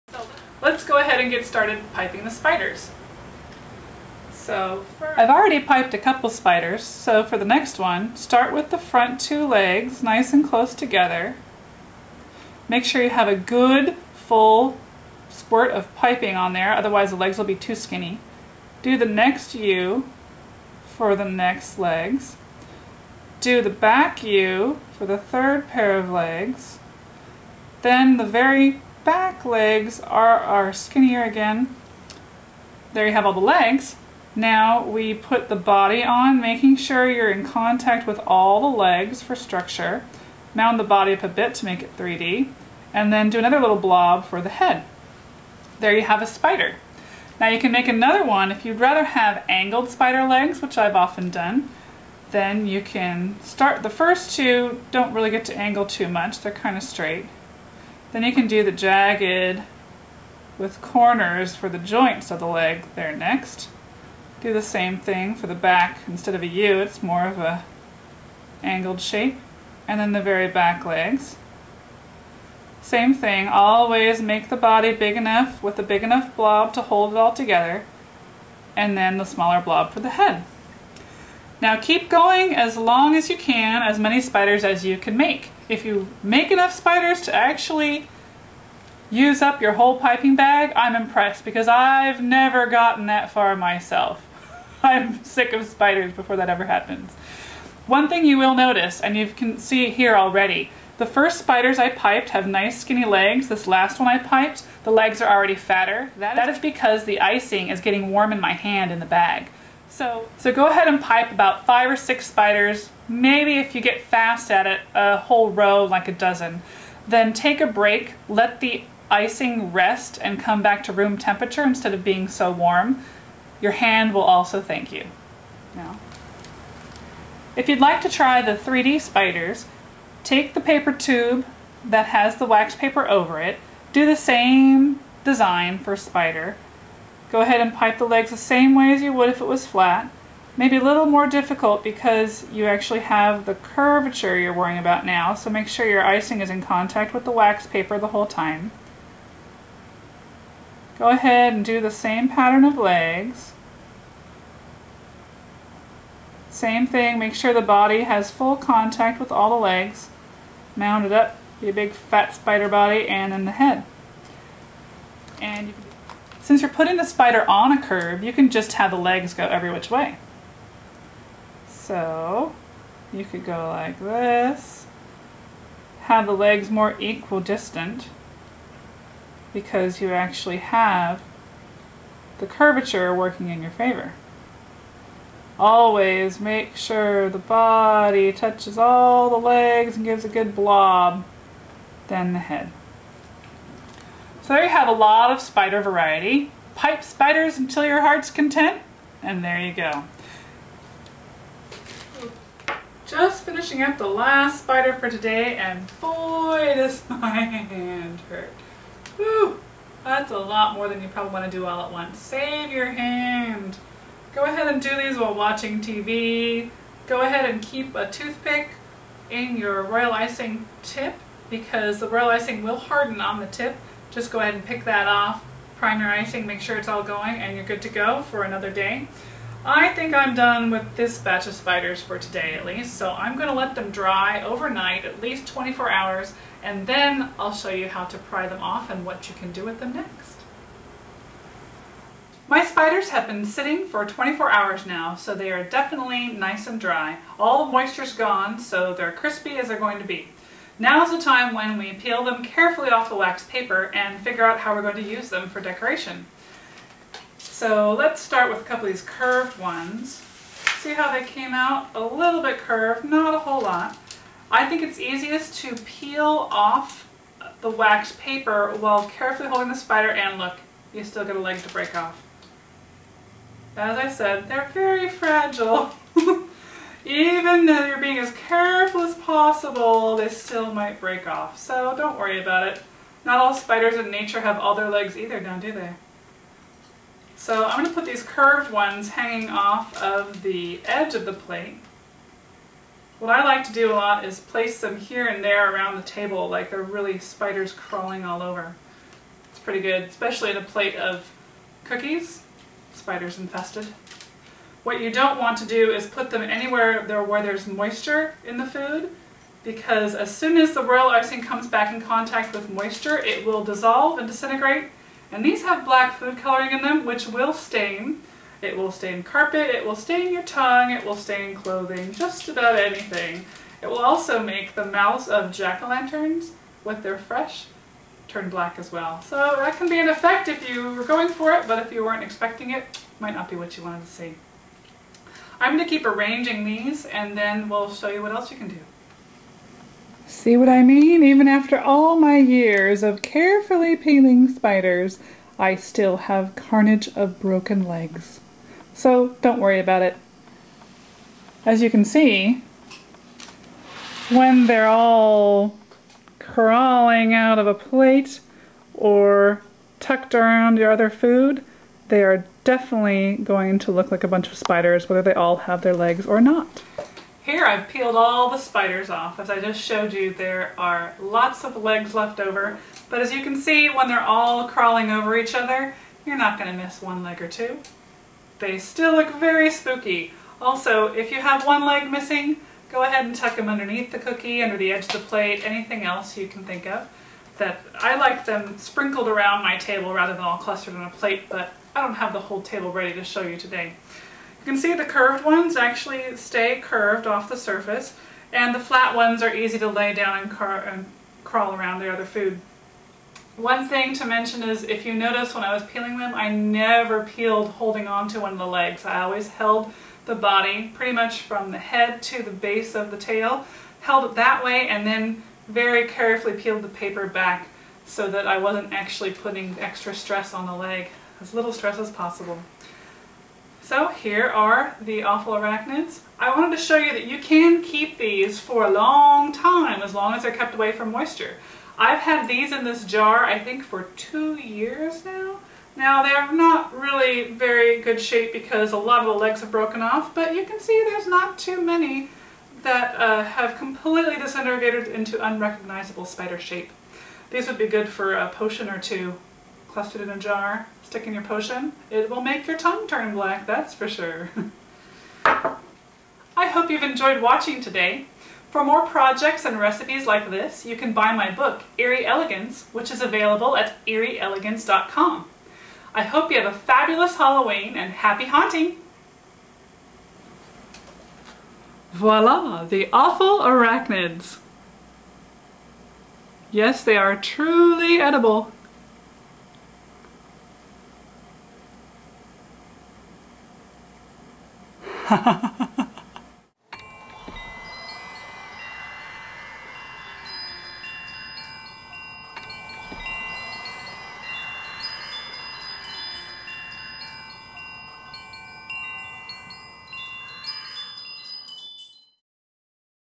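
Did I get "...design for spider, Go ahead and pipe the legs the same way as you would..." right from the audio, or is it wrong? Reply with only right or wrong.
right.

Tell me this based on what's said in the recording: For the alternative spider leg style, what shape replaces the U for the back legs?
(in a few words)
Angled shape.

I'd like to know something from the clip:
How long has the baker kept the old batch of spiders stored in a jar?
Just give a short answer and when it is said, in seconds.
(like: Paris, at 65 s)
2 years, at 434 s.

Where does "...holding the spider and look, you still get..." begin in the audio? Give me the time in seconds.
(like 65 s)
269 s.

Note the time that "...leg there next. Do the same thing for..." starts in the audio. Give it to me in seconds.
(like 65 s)
62 s.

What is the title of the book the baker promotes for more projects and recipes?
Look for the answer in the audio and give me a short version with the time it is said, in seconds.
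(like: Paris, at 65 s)
Eerie Elegance, at 461 s.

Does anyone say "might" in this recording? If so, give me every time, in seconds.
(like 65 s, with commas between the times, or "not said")
280 s, 333 s.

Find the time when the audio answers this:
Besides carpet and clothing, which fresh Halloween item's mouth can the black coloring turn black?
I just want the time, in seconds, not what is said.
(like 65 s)
325 s.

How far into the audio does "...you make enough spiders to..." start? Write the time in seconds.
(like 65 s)
85 s.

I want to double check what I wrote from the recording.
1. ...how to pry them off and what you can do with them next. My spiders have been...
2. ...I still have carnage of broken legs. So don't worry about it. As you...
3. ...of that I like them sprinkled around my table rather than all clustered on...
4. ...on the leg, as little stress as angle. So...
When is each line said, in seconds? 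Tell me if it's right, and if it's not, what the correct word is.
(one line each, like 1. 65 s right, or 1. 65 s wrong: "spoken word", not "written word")
1. 237 s right
2. 345 s right
3. 386 s right
4. 420 s wrong: "possible", not "angle".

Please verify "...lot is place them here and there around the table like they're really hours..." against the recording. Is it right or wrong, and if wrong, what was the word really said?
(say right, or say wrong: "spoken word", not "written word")
wrong: "spiders", not "hours".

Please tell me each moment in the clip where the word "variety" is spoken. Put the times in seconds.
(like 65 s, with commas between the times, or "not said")
195 s.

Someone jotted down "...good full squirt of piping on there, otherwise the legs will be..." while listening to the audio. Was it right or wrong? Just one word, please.
right.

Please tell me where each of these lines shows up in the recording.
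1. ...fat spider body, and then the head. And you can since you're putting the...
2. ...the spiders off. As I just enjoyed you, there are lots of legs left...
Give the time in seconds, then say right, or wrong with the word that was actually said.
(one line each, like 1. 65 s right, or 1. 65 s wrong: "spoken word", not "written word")
1. 161 s right
2. 368 s wrong: "showed", not "enjoyed".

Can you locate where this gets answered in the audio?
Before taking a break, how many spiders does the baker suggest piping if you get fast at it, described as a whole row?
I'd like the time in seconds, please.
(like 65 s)
116 s.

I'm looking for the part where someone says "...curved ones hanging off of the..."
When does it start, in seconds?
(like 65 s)
288 s.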